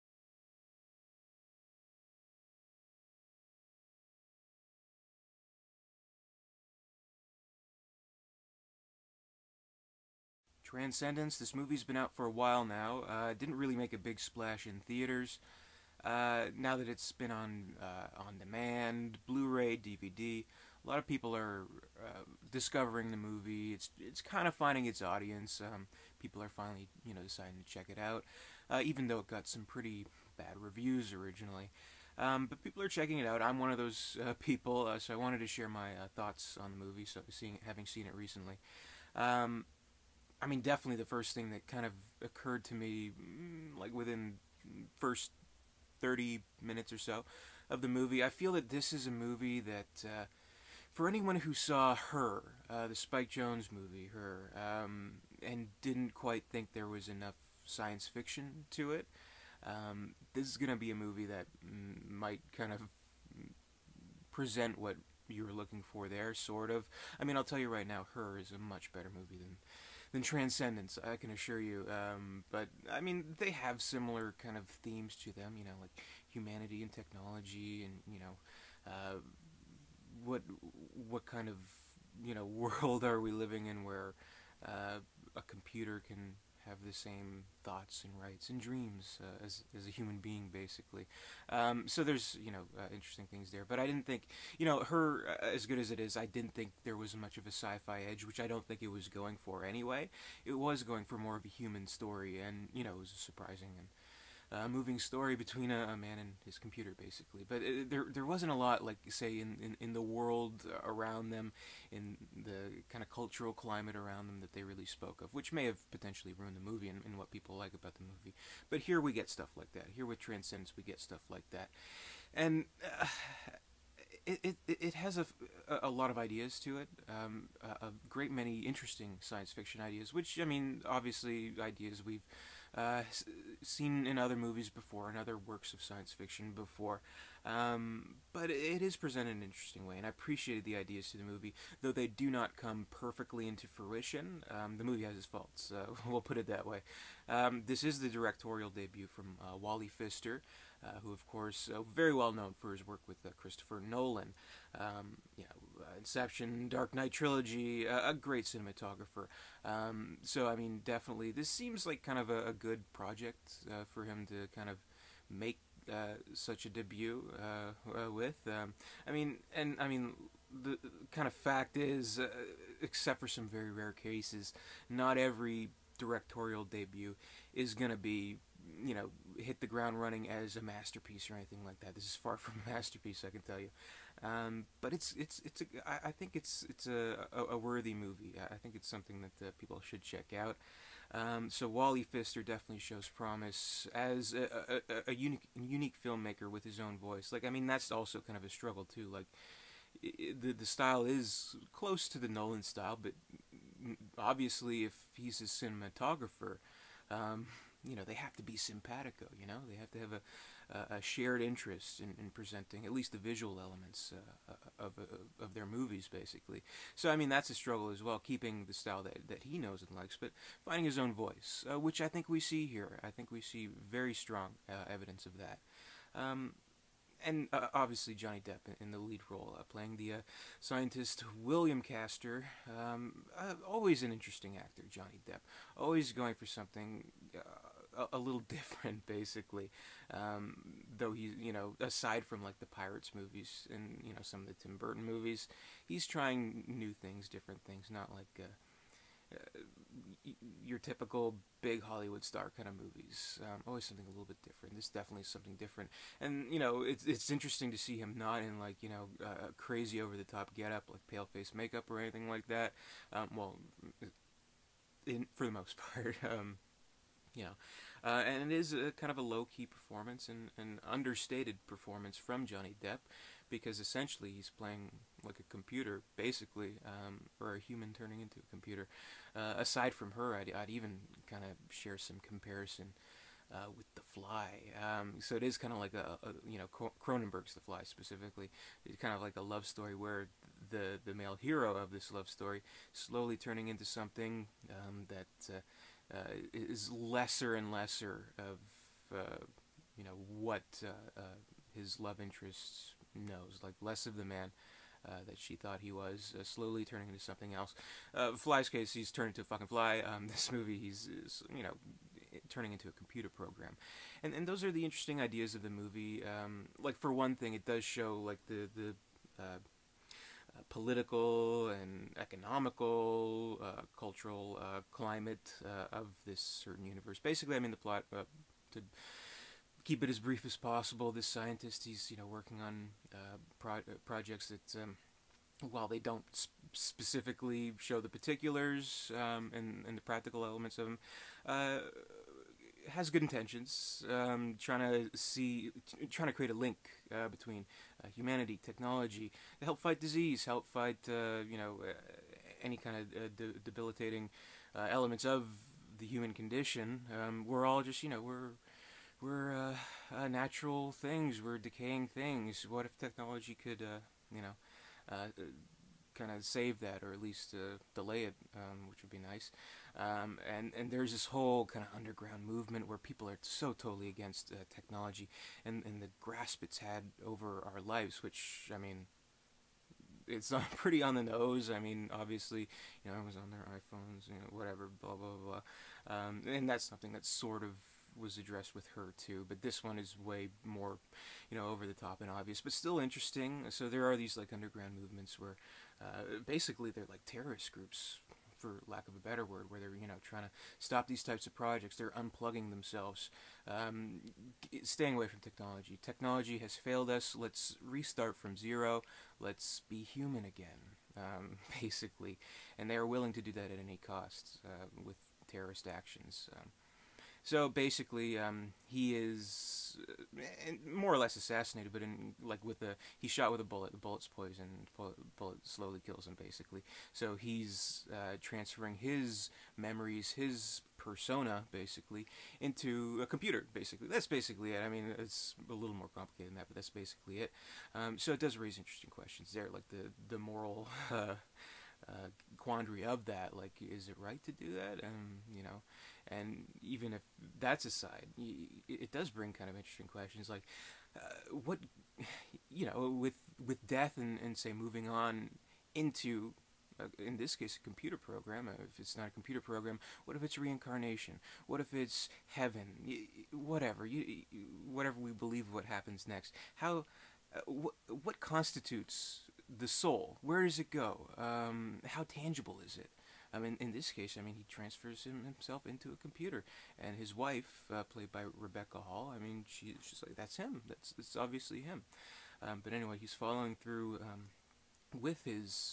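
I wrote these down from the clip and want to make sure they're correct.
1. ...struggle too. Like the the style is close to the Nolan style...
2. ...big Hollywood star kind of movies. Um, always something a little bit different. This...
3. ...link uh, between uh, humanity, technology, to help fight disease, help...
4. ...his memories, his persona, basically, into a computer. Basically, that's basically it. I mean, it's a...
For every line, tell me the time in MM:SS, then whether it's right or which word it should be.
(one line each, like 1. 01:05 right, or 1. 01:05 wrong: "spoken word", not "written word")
1. 03:18 right
2. 04:11 right
3. 05:46 right
4. 07:08 right.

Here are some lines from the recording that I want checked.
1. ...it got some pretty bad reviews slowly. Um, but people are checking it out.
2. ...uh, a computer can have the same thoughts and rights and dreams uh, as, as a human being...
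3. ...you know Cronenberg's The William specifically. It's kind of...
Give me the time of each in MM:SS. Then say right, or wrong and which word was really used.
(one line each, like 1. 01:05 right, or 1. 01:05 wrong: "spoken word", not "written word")
1. 00:29 wrong: "originally", not "slowly"
2. 01:24 right
3. 04:46 wrong: "Fly", not "William".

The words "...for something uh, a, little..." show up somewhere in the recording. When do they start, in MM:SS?
03:56.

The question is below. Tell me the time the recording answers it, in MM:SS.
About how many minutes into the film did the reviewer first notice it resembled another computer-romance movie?
00:46.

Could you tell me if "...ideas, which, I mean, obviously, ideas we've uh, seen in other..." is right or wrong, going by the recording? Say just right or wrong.
right.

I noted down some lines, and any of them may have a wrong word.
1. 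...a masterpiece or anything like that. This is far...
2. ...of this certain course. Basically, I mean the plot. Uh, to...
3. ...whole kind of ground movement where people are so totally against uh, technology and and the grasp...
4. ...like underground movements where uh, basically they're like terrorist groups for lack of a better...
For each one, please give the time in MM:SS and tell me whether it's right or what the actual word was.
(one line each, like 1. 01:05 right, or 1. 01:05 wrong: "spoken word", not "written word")
1. 03:00 right
2. 05:25 wrong: "universe", not "course"
3. 06:11 wrong: "underground", not "ground"
4. 06:34 right.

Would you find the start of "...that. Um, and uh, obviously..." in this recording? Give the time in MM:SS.
03:45.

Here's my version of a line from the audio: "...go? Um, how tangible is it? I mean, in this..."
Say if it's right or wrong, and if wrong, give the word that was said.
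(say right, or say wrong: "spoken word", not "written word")
right.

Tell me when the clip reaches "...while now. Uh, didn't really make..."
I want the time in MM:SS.
00:12.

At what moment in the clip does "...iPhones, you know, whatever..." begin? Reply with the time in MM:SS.
06:23.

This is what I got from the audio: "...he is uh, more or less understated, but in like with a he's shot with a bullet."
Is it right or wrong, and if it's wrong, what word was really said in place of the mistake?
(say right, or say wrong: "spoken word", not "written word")
wrong: "assassinated", not "understated".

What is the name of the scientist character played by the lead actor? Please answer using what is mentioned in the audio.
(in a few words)
William Caster.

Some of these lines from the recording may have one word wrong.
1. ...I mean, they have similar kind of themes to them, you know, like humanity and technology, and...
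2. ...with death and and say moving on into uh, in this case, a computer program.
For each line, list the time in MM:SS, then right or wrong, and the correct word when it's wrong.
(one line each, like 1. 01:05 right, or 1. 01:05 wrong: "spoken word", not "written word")
1. 01:12 right
2. 07:33 right.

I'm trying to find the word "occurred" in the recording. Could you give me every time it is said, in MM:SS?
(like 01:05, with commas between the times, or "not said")
00:42.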